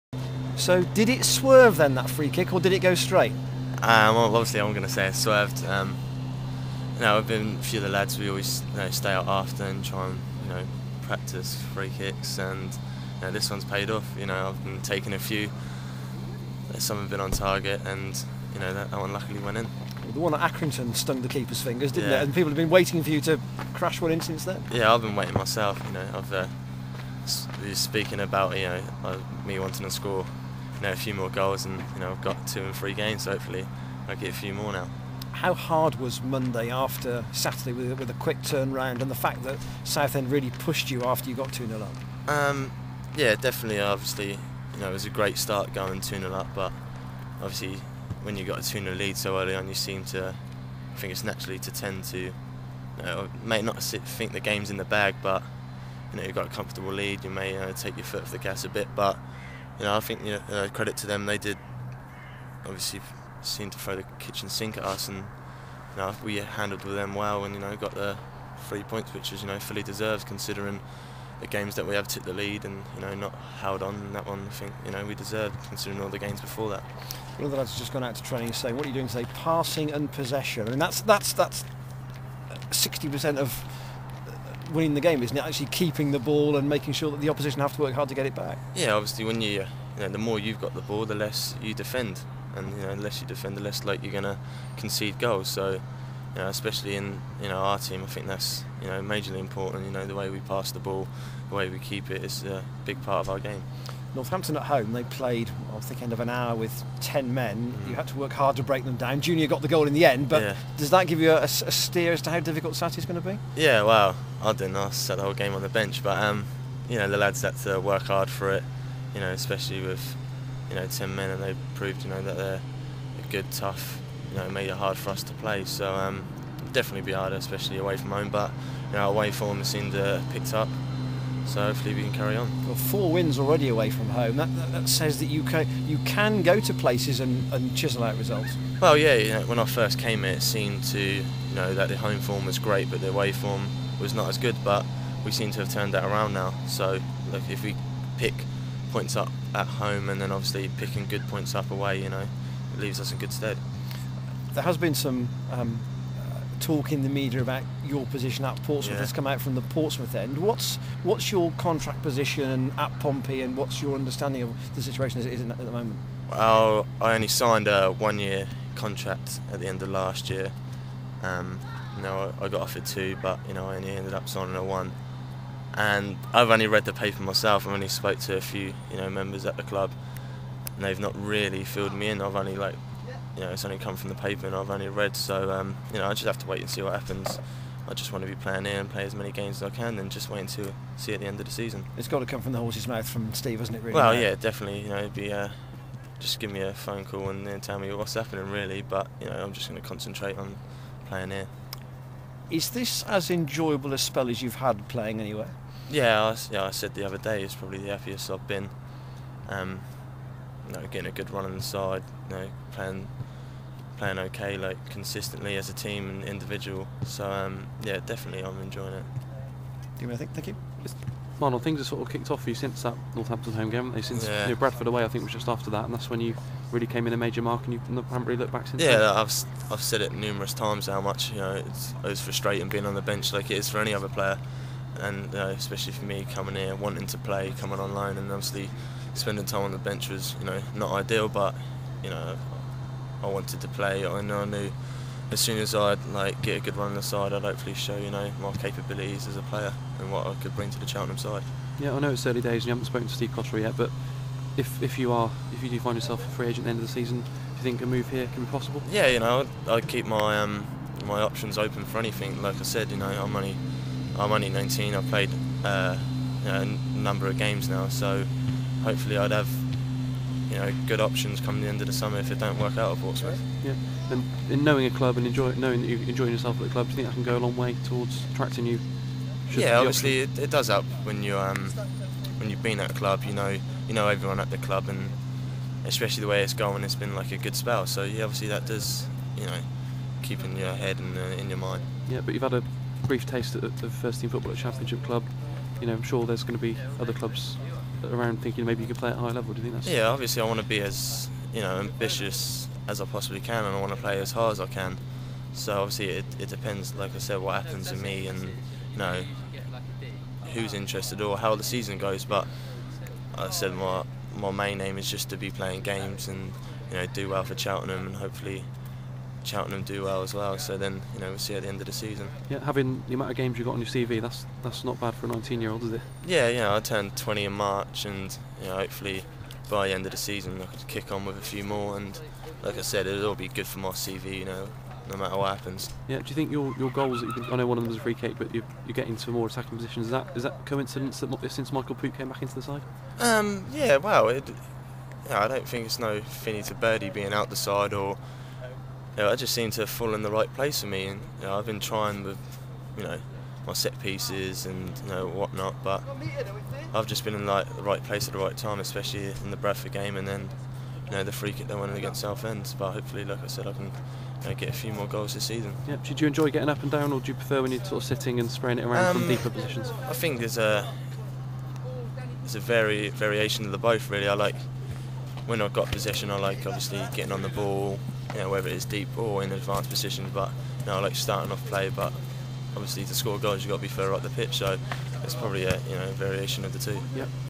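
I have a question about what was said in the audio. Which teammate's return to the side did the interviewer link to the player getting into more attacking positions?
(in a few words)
Michael Pook.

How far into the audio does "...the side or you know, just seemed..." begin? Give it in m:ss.
5:47.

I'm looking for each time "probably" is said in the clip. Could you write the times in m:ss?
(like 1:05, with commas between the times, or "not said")
3:27, 6:25.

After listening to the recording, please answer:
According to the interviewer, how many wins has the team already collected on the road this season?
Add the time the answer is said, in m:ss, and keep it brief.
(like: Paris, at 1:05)
4, at 2:12.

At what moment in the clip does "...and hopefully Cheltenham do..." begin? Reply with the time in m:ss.
5:18.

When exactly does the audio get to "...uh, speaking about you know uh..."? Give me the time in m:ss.
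0:26.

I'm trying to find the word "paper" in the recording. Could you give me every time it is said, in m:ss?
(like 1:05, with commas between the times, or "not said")
2:56, 3:04.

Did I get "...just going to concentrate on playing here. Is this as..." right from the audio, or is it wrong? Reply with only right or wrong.
right.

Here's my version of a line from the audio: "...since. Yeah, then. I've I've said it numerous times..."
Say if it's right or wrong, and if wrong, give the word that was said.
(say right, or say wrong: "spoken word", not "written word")
right.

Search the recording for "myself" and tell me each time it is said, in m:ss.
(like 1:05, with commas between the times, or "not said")
0:25, 2:57.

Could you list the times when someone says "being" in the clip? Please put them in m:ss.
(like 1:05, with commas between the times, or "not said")
3:52, 5:47.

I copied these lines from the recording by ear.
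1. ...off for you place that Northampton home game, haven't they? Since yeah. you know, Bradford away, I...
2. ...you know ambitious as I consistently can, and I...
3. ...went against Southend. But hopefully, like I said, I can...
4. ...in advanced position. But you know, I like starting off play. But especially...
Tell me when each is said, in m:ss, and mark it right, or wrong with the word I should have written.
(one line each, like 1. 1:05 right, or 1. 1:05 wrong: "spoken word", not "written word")
1. 3:42 wrong: "since", not "place"
2. 5:01 wrong: "possibly", not "consistently"
3. 6:01 right
4. 6:19 wrong: "obviously", not "especially".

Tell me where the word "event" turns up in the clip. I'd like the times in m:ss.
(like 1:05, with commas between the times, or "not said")
not said.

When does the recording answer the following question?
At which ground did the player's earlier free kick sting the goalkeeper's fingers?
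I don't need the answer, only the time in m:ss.
0:20.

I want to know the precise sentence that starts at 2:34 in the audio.
There has been some um, talk in the media about your position at Portsmouth yeah.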